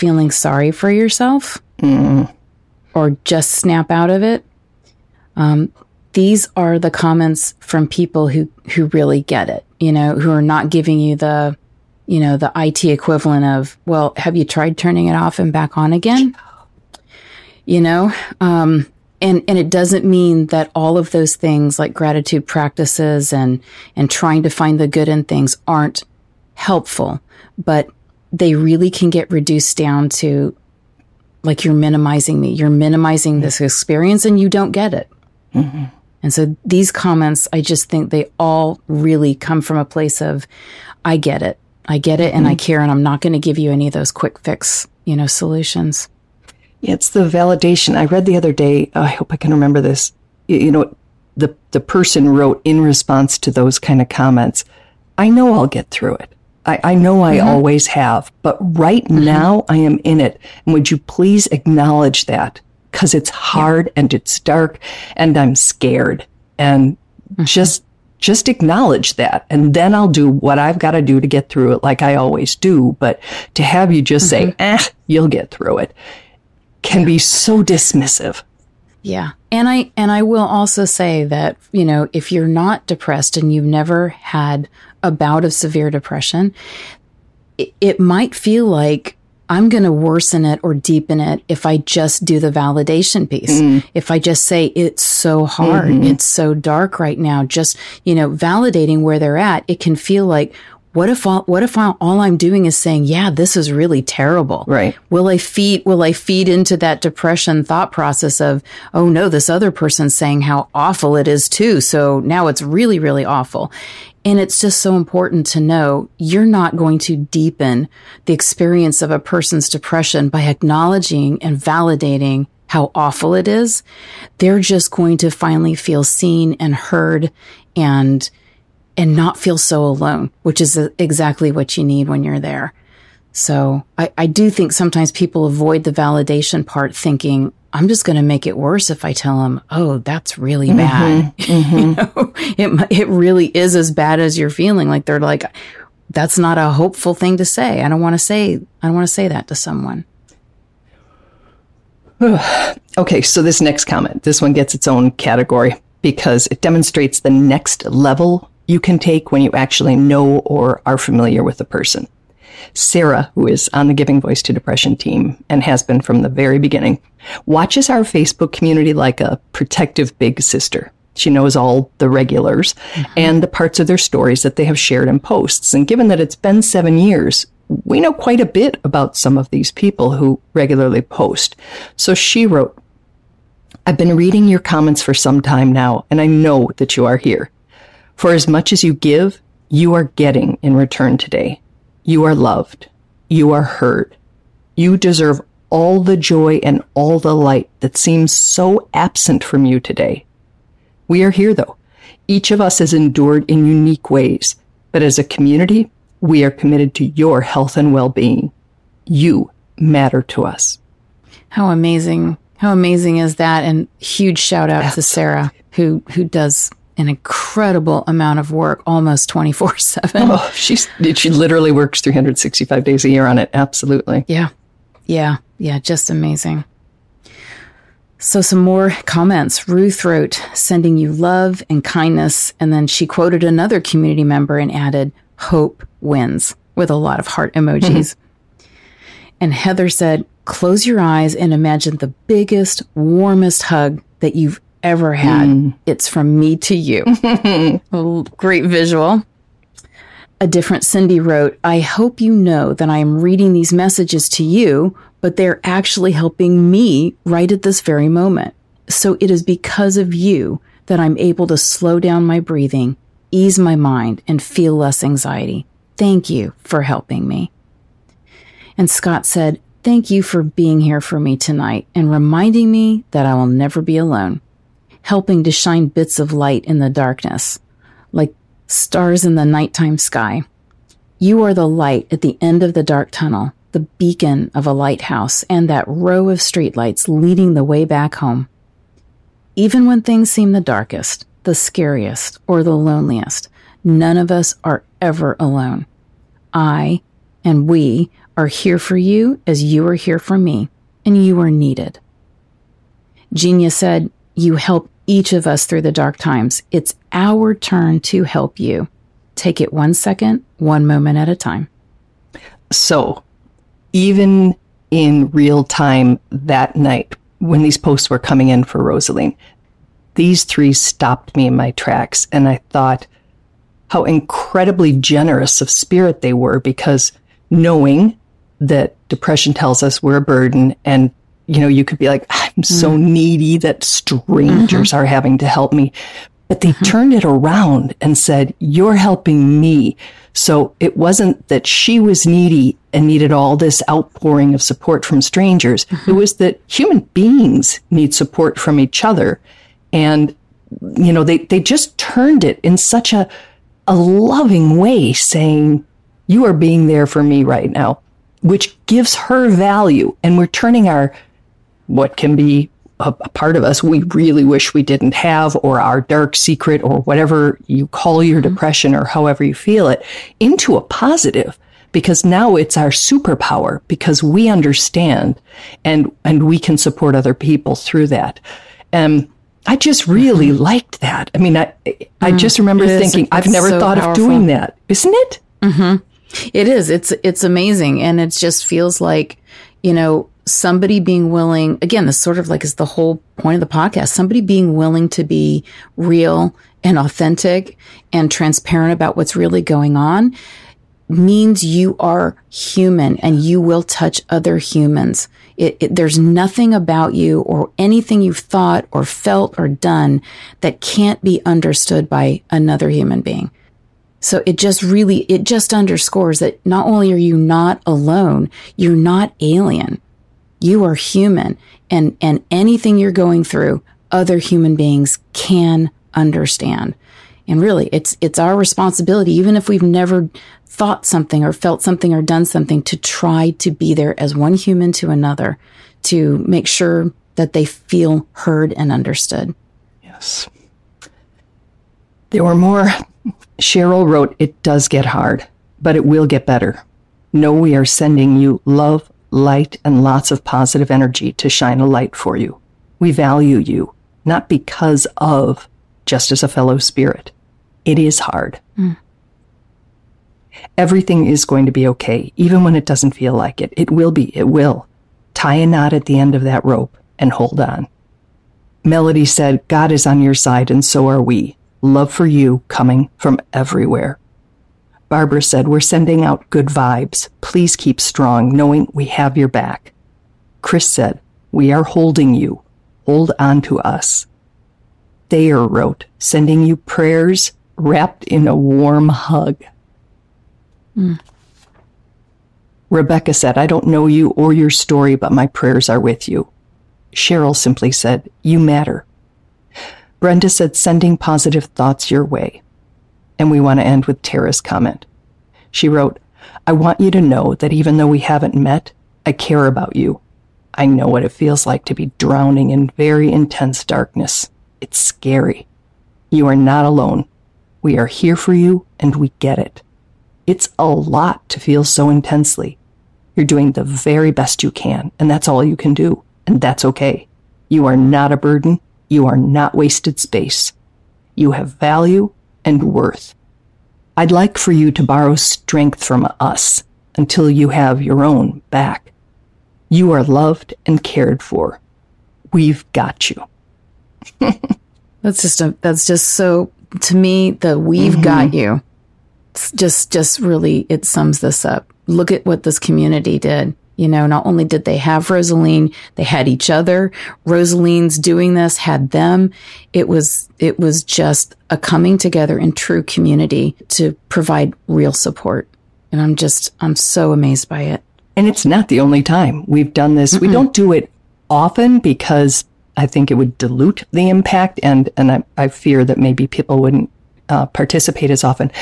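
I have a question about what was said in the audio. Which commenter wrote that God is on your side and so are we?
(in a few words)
Melody.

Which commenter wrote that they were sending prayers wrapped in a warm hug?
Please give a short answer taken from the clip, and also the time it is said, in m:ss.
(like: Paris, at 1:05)
Thayer, at 8:05.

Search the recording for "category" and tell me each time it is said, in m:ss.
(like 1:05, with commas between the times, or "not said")
2:35.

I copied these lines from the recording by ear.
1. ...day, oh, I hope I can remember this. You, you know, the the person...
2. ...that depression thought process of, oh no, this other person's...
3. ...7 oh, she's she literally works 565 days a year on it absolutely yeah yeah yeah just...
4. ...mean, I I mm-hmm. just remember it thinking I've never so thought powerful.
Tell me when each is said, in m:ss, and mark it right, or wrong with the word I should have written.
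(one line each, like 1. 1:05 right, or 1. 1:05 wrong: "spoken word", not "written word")
1. 0:48 right
2. 1:46 right
3. 3:39 wrong: "365", not "565"
4. 6:21 right.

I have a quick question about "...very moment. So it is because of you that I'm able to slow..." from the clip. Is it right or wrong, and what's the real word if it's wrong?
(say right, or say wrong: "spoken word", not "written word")
right.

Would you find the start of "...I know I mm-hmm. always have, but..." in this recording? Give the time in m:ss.
0:56.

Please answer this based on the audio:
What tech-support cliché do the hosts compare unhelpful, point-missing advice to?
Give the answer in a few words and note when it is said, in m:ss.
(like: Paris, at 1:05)
turning it off and back on again, at 0:14.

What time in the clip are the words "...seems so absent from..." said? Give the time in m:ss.
3:17.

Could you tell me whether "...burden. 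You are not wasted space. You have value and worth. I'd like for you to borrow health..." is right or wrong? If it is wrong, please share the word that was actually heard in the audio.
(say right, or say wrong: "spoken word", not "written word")
wrong: "strength", not "health".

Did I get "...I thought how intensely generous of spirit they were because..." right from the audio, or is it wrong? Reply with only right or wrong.
wrong.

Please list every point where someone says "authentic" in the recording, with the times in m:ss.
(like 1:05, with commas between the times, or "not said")
6:36.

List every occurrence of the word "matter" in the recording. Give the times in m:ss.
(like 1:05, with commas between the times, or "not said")
3:29, 8:18.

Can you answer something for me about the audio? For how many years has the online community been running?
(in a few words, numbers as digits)
7.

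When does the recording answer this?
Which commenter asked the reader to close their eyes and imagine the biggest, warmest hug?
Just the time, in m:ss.
3:59.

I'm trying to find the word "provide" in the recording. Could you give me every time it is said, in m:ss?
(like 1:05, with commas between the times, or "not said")
9:24.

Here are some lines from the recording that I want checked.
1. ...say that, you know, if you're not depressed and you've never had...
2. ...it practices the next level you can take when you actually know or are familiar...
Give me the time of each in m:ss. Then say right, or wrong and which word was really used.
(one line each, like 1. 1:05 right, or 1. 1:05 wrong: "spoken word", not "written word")
1. 1:20 right
2. 2:36 wrong: "demonstrates", not "practices".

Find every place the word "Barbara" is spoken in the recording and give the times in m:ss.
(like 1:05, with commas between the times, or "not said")
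7:55.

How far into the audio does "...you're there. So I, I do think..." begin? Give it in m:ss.
2:12.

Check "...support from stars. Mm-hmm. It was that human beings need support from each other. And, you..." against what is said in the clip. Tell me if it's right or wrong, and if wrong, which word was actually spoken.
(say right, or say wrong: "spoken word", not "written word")
wrong: "strangers", not "stars".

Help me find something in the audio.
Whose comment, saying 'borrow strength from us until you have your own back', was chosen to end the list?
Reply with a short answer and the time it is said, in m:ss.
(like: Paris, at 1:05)
Tara, at 8:24.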